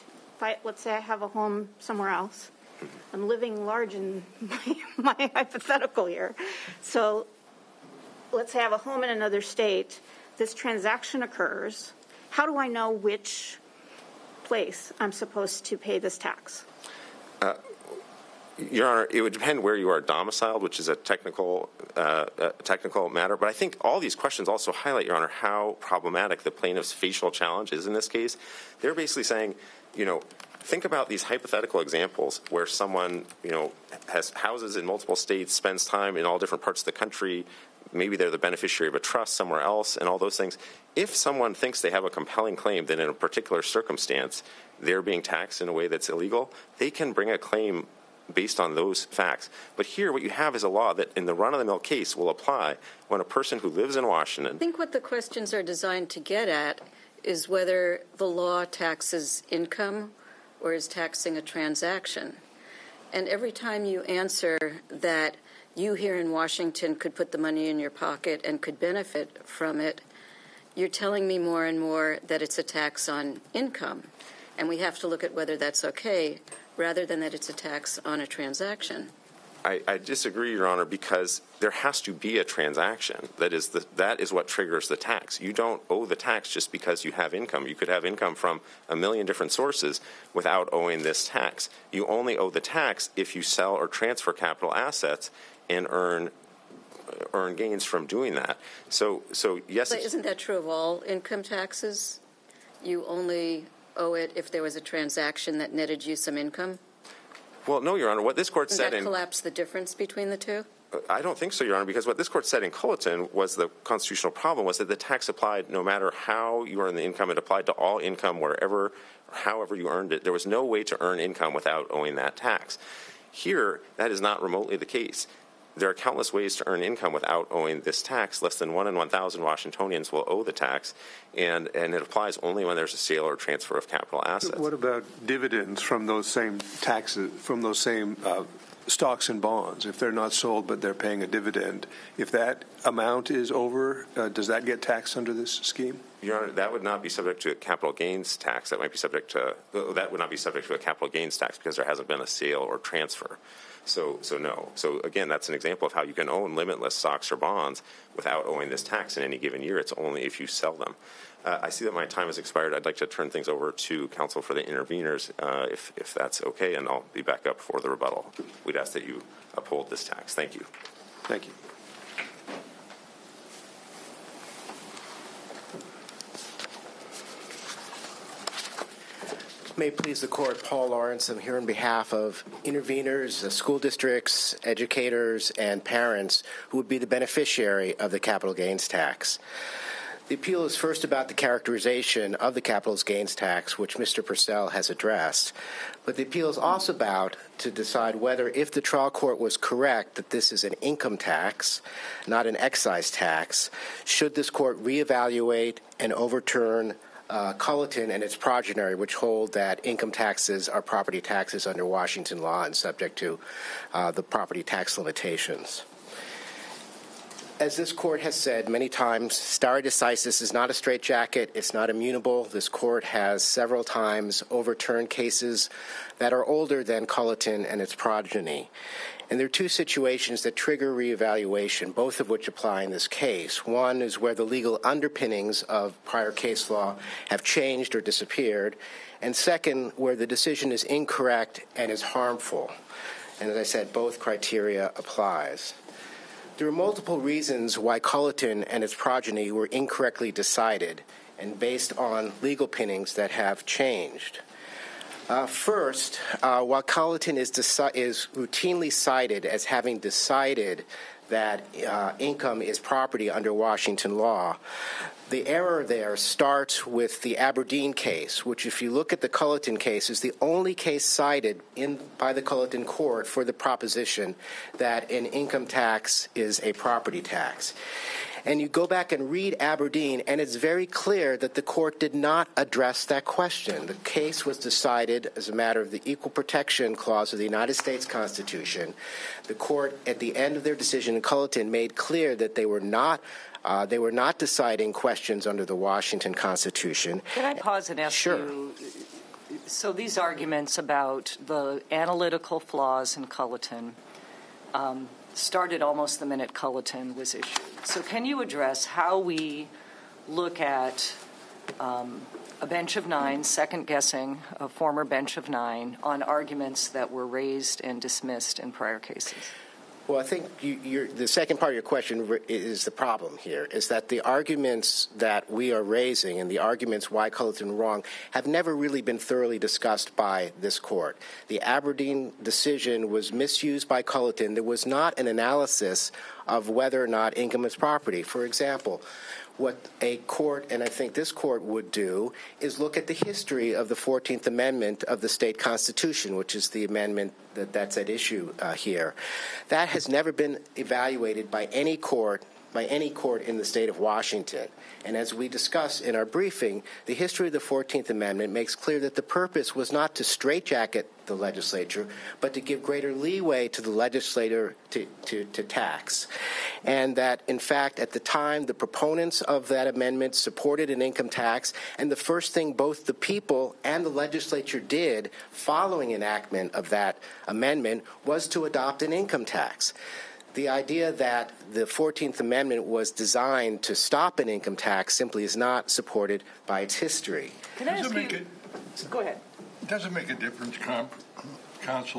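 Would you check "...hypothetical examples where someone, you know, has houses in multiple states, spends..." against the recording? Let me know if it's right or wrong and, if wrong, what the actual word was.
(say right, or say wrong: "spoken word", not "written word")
right.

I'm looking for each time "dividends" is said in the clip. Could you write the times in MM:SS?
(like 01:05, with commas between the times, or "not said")
02:15, 02:21.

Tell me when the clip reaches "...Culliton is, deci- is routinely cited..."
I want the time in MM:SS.
04:16.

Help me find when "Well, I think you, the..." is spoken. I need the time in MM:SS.
05:20.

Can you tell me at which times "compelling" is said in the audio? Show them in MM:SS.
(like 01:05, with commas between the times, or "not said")
00:42.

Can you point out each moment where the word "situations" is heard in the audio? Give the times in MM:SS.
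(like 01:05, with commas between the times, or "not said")
03:49.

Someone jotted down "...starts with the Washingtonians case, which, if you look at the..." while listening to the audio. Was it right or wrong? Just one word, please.
wrong.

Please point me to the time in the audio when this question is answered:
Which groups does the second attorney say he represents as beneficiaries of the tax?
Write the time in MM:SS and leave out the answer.
03:03.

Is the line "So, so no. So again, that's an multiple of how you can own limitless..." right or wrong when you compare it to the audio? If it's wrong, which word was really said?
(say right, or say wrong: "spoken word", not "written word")
wrong: "example", not "multiple".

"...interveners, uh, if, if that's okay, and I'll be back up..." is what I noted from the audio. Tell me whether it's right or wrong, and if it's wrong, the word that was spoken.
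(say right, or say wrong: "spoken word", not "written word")
right.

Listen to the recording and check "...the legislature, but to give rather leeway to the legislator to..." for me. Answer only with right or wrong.
wrong.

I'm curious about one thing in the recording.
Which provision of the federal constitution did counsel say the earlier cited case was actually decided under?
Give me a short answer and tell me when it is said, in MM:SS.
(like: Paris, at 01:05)
Equal Protection Clause, at 04:46.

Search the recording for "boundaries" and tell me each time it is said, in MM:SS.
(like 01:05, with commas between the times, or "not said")
not said.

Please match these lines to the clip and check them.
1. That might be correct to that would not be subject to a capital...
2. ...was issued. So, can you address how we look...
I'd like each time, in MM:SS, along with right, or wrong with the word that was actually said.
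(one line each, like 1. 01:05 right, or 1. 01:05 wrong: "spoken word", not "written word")
1. 02:28 wrong: "subject", not "correct"
2. 05:07 right.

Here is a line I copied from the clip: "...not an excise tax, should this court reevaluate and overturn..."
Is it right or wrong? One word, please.
right.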